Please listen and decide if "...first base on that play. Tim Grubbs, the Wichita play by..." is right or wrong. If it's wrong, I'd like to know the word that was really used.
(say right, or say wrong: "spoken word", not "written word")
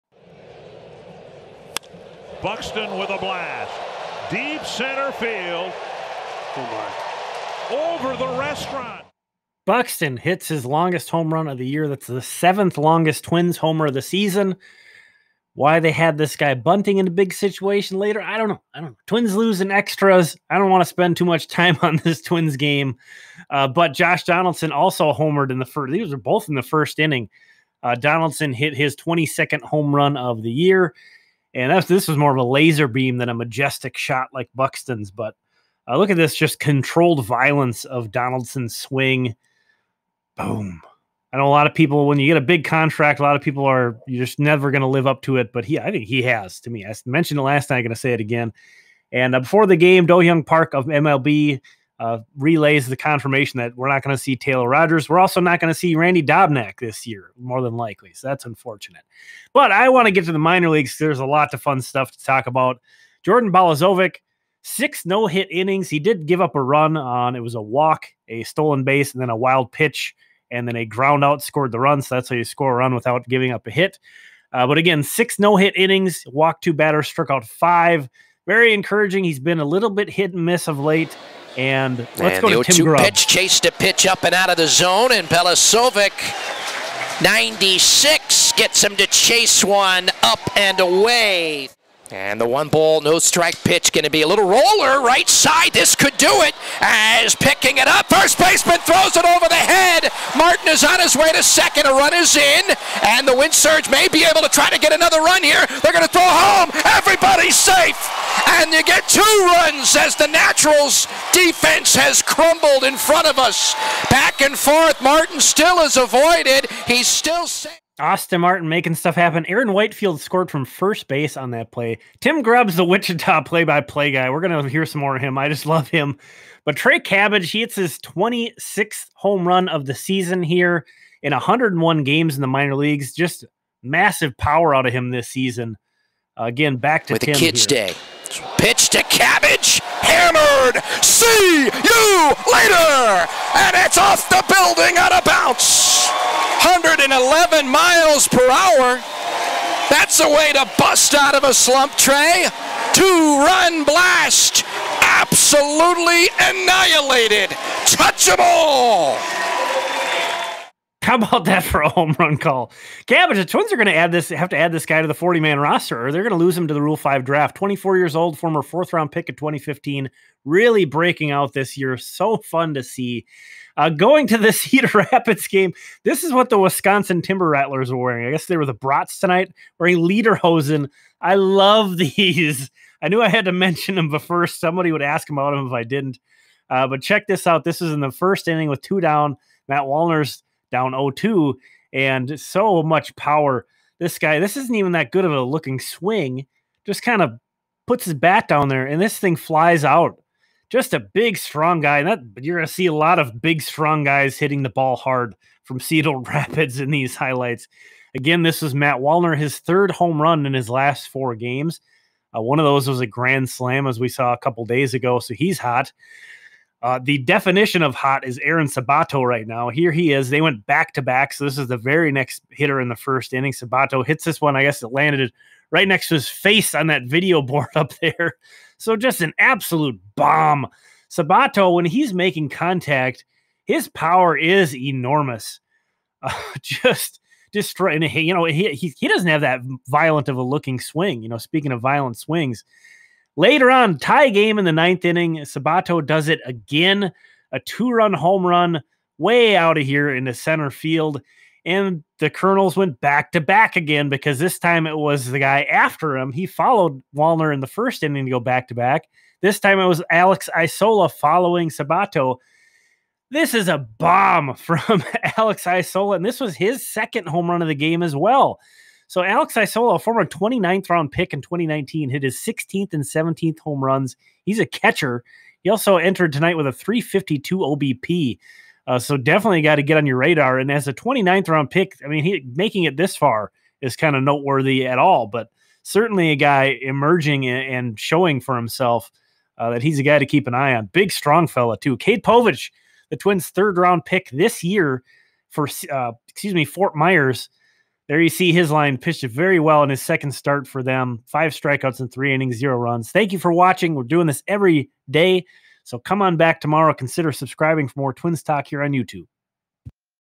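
right.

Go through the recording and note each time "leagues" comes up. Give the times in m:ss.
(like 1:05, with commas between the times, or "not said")
1:00, 2:12.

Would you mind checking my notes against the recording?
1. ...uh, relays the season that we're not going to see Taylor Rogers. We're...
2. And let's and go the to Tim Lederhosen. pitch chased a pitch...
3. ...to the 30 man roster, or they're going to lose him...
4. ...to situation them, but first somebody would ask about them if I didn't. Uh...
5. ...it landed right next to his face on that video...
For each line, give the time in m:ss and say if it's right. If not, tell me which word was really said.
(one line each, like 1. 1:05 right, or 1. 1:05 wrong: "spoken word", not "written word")
1. 0:52 wrong: "confirmation", not "season"
2. 1:21 wrong: "Grubb", not "Lederhosen"
3. 2:45 wrong: "40", not "30"
4. 3:03 wrong: "mention", not "situation"
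5. 3:44 right.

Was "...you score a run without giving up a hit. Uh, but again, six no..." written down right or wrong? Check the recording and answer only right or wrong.
right.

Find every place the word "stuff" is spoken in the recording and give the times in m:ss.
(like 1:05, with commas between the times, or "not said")
1:01, 1:58.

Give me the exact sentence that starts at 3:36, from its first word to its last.
Uh, the definition of hot is Aaron Sabato right now.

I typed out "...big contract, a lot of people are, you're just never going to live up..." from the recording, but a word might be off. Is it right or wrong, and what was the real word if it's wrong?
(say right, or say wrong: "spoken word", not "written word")
right.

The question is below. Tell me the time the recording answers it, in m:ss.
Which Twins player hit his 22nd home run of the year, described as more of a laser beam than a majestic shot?
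0:23.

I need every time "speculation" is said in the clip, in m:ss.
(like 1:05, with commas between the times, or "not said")
not said.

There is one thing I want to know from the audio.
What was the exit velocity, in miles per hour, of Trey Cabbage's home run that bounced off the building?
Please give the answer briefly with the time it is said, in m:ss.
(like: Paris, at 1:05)
111, at 2:26.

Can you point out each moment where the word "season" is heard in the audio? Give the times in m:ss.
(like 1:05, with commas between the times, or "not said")
0:14, 2:09, 2:15.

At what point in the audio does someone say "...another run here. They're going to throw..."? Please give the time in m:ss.
1:44.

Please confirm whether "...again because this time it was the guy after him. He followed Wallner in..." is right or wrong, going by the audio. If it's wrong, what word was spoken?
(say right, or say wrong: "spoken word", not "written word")
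right.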